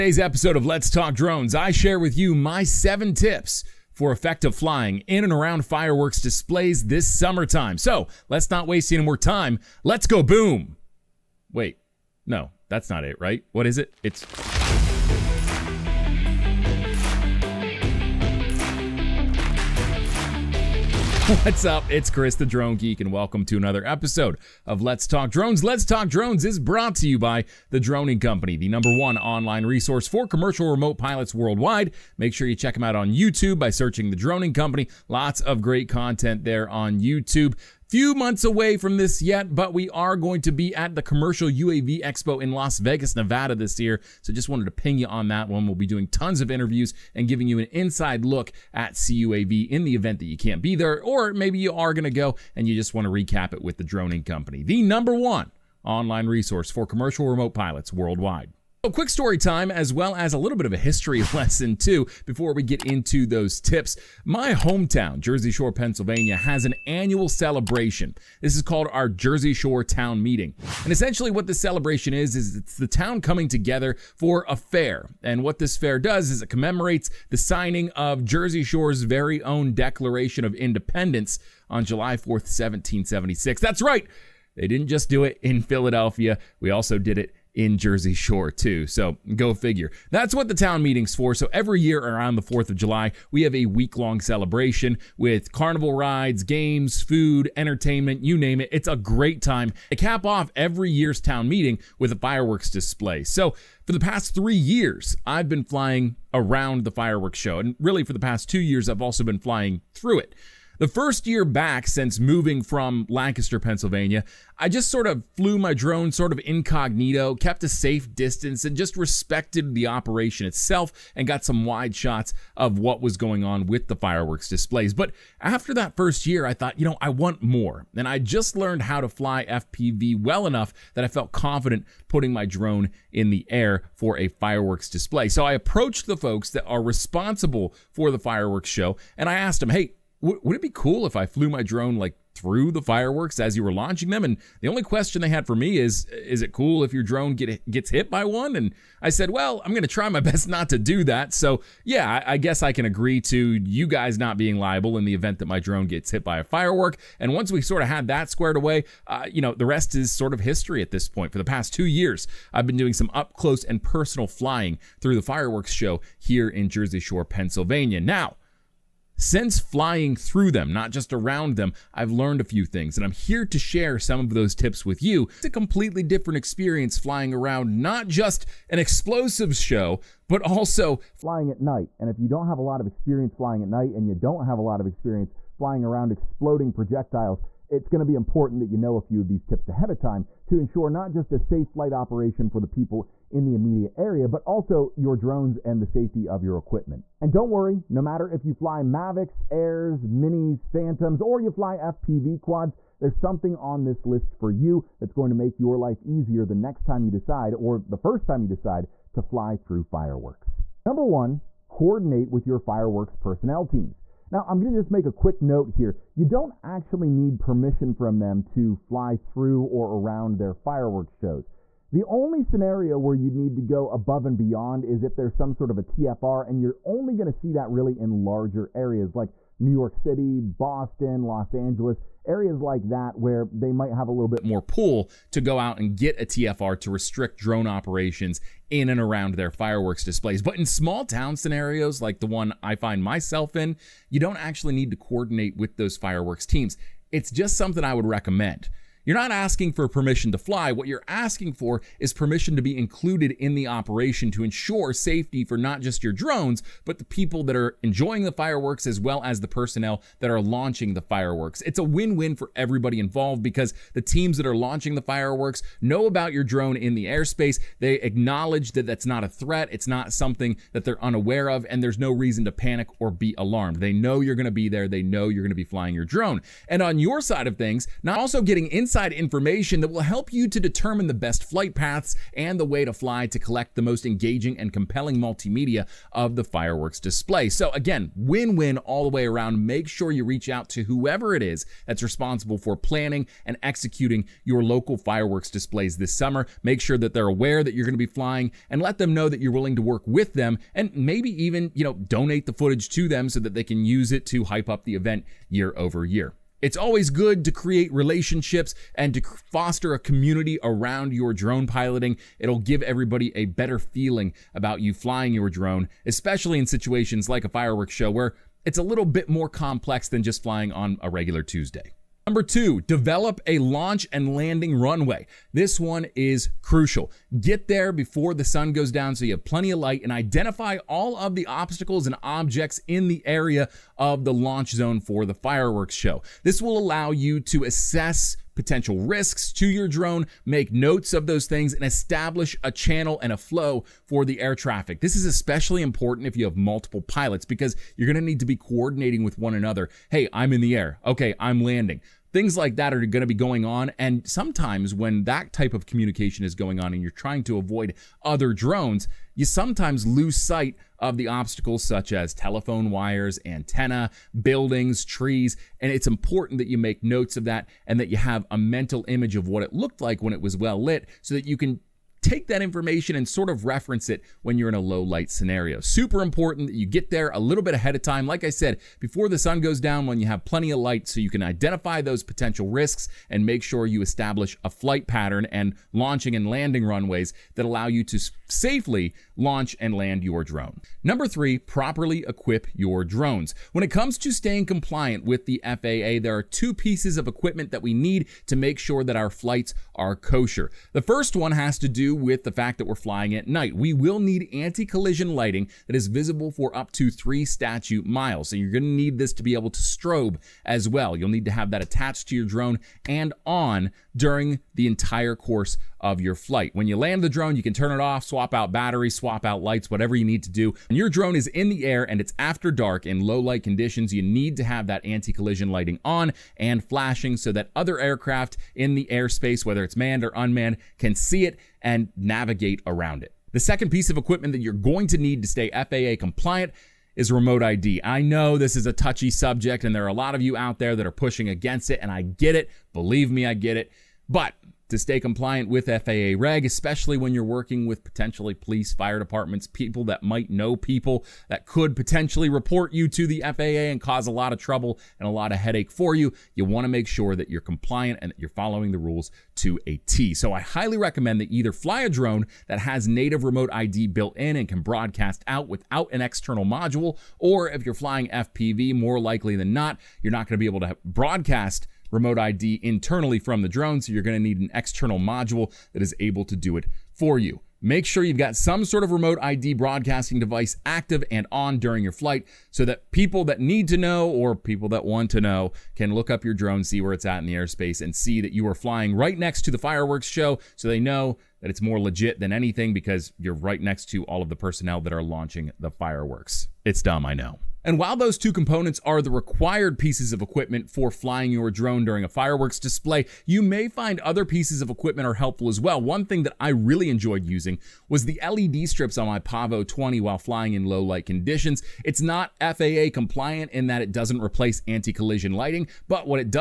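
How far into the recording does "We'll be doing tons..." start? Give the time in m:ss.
0:45.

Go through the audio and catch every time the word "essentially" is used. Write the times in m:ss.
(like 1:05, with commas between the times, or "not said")
1:10.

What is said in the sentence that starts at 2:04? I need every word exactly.
But after that first year, I thought, you know, I want more.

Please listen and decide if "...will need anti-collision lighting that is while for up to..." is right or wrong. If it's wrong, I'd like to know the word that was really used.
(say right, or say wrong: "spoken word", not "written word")
wrong: "visible", not "while".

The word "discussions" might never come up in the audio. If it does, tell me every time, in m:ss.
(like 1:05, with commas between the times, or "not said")
not said.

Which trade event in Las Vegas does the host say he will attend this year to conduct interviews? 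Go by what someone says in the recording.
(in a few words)
Commercial UAV Expo.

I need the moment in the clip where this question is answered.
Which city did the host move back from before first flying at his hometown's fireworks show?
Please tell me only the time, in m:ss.
1:53.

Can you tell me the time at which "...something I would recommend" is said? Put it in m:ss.
4:07.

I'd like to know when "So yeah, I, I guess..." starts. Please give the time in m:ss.
2:31.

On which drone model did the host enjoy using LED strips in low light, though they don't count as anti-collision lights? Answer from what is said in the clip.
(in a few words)
Pavo 20.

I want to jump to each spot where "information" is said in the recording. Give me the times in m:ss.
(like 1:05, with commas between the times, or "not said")
4:39, 6:12.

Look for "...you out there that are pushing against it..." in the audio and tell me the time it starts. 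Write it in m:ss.
7:20.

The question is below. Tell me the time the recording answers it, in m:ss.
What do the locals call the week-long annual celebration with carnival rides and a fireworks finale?
1:09.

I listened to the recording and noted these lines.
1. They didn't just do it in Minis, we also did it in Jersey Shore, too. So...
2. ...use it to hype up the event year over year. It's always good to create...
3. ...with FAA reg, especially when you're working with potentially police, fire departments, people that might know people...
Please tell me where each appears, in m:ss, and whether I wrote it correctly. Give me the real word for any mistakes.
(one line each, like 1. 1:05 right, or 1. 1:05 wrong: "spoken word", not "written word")
1. 1:24 wrong: "Philadelphia", not "Minis"
2. 5:03 right
3. 7:25 right.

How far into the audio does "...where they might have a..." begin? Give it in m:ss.
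3:53.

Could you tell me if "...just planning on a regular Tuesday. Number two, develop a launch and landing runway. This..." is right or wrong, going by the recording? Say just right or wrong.
wrong.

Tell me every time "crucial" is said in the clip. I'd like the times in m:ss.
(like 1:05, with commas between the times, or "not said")
5:26.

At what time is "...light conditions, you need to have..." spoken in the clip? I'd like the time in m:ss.
7:03.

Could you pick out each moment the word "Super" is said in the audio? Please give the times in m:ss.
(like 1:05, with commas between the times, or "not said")
6:15.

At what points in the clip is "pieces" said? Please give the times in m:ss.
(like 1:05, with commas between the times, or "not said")
6:36, 7:13, 8:19, 8:24.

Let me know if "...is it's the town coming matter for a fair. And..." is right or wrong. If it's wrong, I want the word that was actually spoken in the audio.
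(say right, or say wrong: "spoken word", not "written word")
wrong: "together", not "matter".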